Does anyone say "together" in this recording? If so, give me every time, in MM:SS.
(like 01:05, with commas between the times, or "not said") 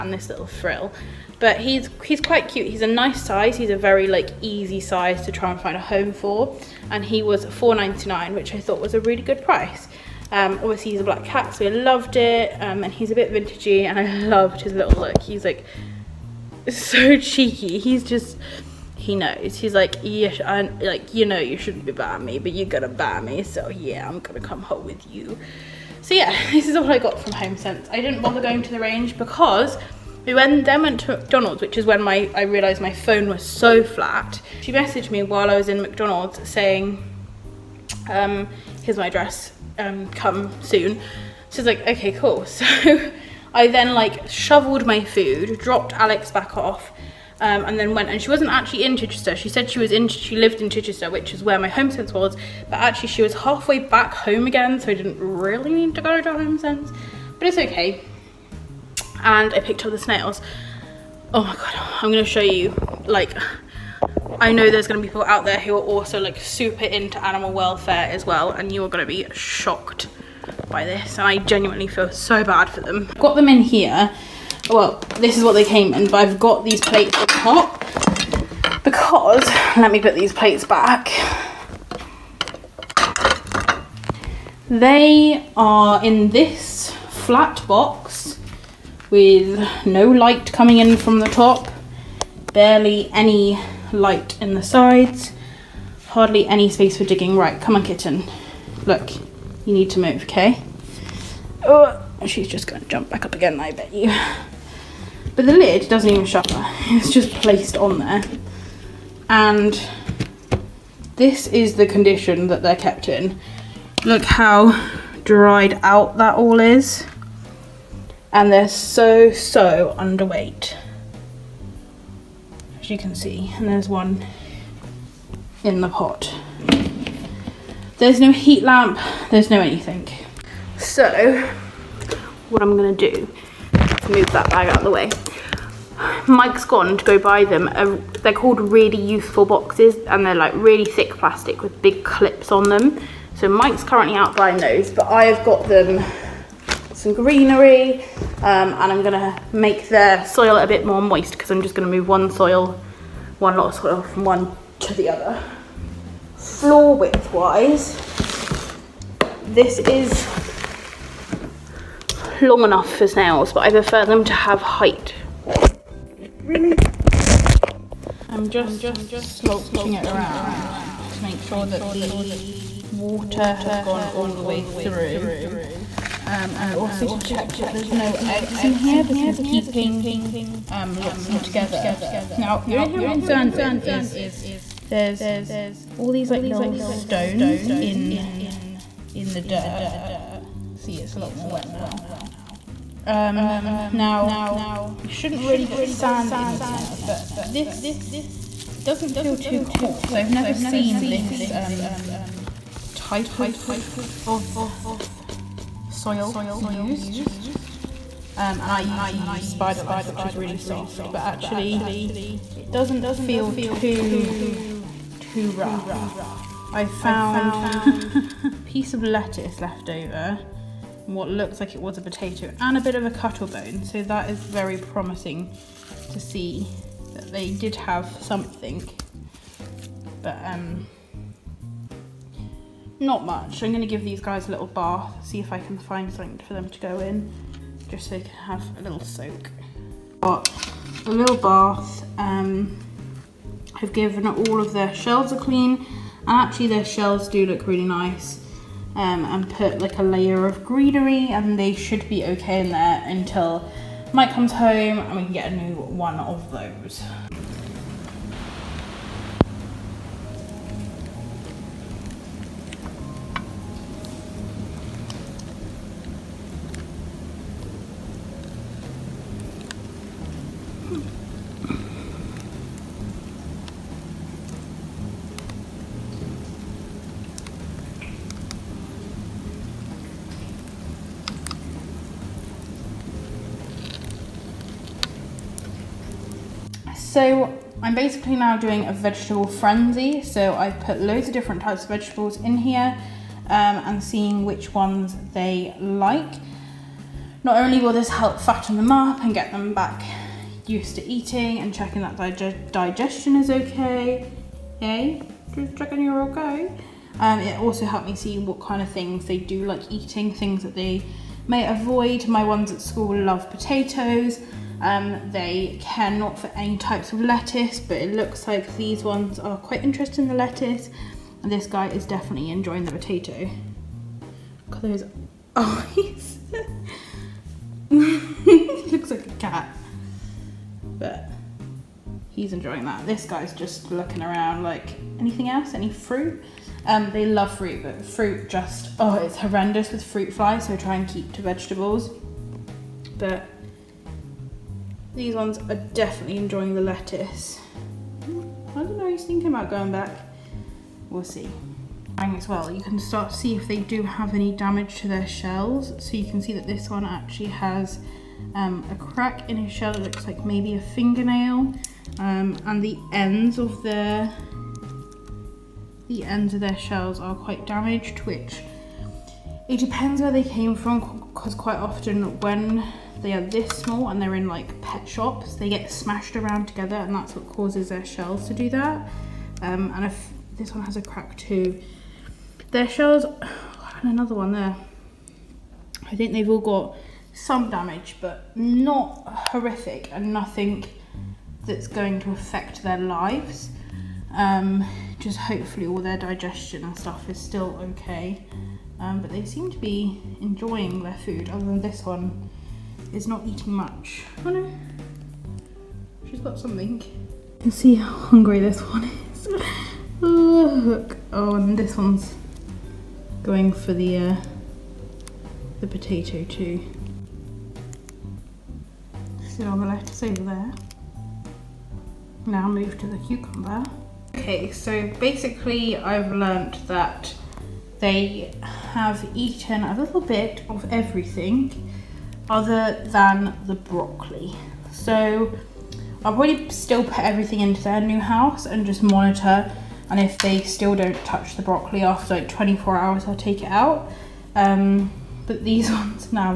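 03:01, 06:16.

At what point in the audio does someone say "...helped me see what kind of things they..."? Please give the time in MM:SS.
05:07.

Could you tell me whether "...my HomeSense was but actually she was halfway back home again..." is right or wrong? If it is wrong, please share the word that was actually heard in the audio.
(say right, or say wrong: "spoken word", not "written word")
right.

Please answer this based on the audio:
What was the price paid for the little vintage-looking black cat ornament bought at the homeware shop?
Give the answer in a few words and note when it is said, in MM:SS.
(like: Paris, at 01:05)
4.99, at 00:07.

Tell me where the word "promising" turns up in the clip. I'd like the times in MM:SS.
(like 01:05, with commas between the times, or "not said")
03:44.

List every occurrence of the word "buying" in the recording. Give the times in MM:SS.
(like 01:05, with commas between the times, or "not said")
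00:21, 02:24.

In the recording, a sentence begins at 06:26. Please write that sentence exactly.
I think they've all got some damage, but not horrific and nothing that's going to affect their lives.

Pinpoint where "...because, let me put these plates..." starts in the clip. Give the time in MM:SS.
01:18.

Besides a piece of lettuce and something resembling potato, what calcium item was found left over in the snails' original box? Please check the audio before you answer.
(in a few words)
cuttle bone.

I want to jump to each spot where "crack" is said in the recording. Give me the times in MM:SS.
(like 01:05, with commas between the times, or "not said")
05:58, 06:21.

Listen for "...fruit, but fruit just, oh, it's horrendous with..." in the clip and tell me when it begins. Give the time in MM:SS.
05:37.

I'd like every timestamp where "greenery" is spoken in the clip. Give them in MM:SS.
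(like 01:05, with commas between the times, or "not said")
02:27, 04:10.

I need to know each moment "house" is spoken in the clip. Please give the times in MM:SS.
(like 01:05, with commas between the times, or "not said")
07:18.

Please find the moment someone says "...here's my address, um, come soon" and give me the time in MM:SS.
00:38.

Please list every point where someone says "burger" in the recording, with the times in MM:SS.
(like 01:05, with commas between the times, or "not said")
not said.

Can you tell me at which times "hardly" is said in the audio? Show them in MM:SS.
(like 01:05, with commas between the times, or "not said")
01:36.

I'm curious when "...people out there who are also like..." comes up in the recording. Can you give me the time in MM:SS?
01:05.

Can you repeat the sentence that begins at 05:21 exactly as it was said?
And this guy is definitely enjoying the potato.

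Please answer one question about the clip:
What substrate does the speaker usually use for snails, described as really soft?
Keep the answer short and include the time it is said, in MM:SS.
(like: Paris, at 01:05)
Spider Life, at 03:29.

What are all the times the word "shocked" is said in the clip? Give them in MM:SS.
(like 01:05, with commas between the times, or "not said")
01:09.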